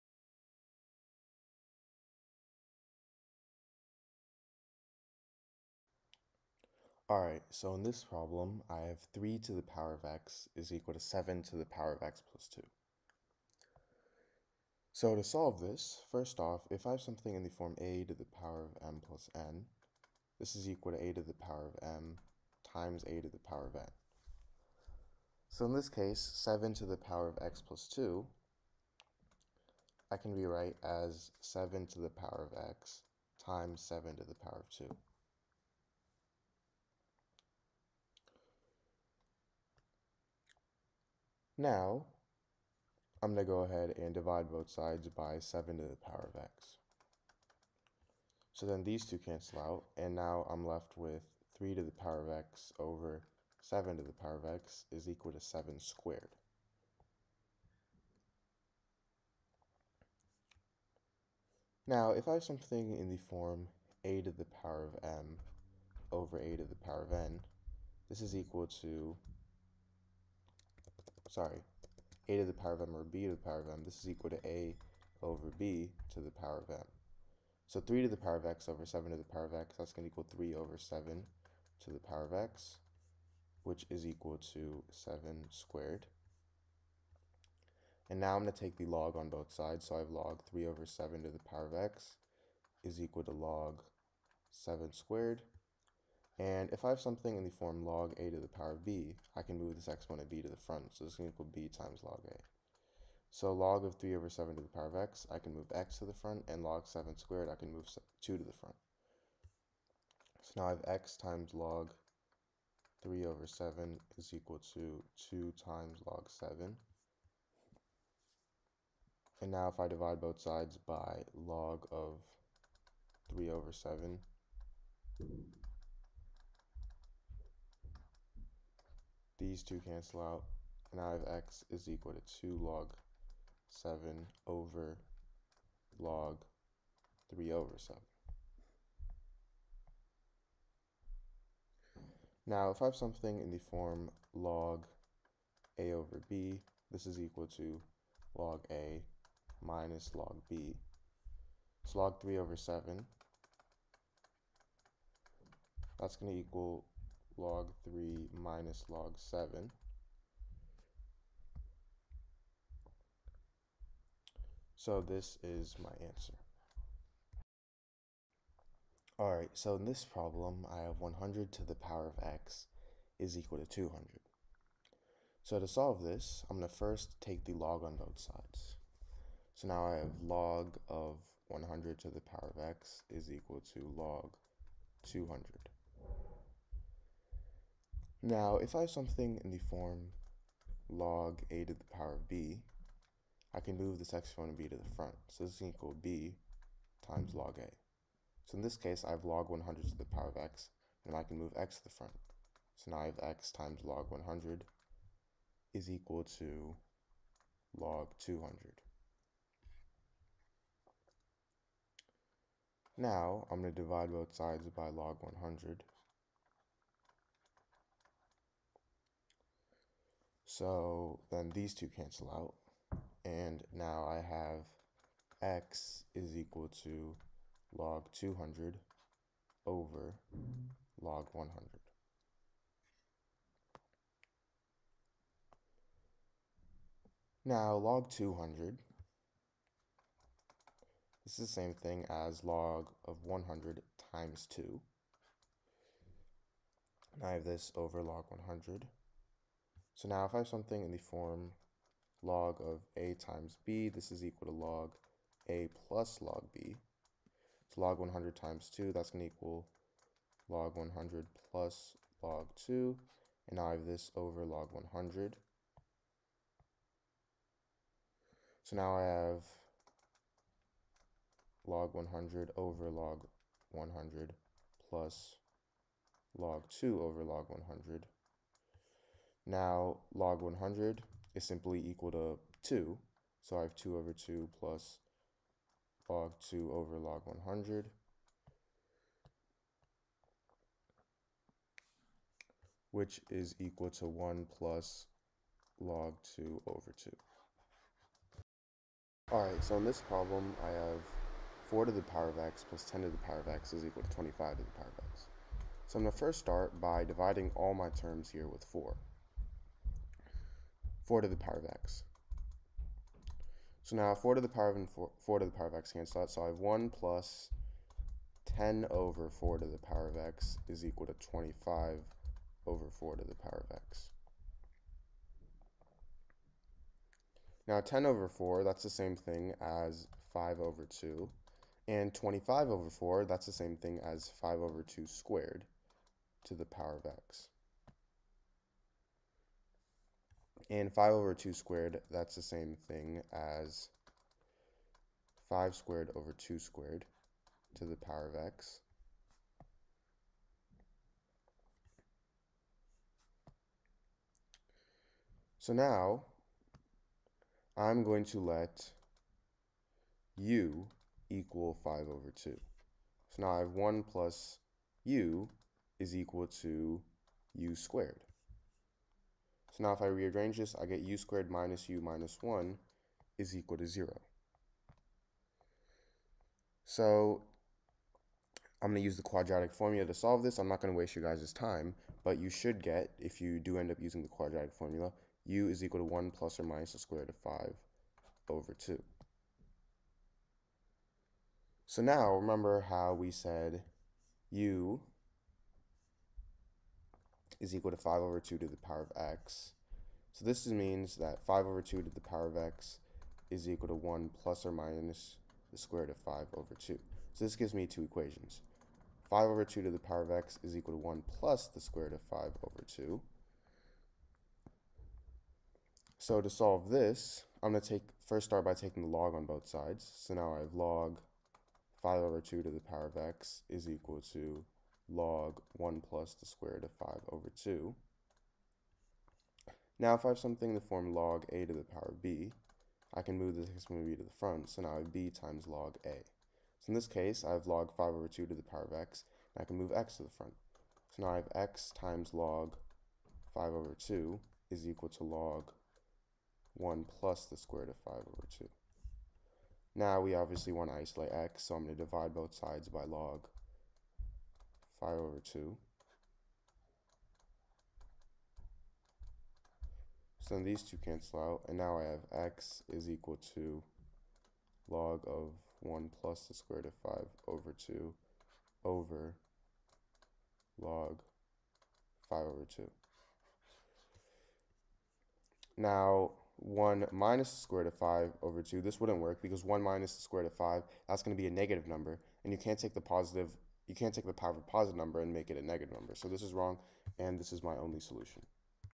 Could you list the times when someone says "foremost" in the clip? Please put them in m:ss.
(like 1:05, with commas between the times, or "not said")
not said.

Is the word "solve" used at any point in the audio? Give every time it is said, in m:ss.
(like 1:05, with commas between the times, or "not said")
0:15, 2:55, 6:20, 6:56.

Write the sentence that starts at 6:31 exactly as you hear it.
So now remember how we said u is equal to 5 over 2 to the power of x.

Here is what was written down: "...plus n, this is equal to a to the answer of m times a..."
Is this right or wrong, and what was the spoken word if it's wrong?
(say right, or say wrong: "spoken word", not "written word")
wrong: "power", not "answer".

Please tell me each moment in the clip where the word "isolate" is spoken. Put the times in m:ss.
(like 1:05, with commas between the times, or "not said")
7:30.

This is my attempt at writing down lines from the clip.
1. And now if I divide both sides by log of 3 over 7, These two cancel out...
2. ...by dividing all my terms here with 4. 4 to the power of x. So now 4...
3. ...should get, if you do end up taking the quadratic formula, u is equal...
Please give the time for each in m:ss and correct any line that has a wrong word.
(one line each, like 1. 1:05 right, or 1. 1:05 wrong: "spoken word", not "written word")
1. 1:59 right
2. 5:06 right
3. 6:22 wrong: "using", not "taking".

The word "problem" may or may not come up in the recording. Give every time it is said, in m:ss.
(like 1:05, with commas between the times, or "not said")
0:08, 2:50, 5:00.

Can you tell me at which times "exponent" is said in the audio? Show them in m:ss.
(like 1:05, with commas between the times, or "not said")
1:39, 3:14, 7:13.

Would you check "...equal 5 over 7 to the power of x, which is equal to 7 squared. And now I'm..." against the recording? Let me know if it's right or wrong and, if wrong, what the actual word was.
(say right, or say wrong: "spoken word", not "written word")
wrong: "3", not "5".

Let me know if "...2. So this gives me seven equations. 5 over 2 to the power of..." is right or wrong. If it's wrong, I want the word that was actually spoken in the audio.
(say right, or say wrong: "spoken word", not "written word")
wrong: "two", not "seven".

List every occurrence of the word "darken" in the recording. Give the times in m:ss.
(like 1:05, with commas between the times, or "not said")
not said.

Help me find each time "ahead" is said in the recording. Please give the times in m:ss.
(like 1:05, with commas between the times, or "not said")
0:43.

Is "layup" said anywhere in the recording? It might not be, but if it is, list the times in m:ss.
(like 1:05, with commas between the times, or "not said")
not said.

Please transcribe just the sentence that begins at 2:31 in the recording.
So log 3 over 7, that's going to equal log 3 minus log 7.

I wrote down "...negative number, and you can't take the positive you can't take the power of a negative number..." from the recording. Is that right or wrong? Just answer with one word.
wrong.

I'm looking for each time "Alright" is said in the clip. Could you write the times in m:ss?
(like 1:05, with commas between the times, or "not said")
0:07, 2:49, 4:59.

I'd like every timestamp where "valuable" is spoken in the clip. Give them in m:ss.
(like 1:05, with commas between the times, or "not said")
not said.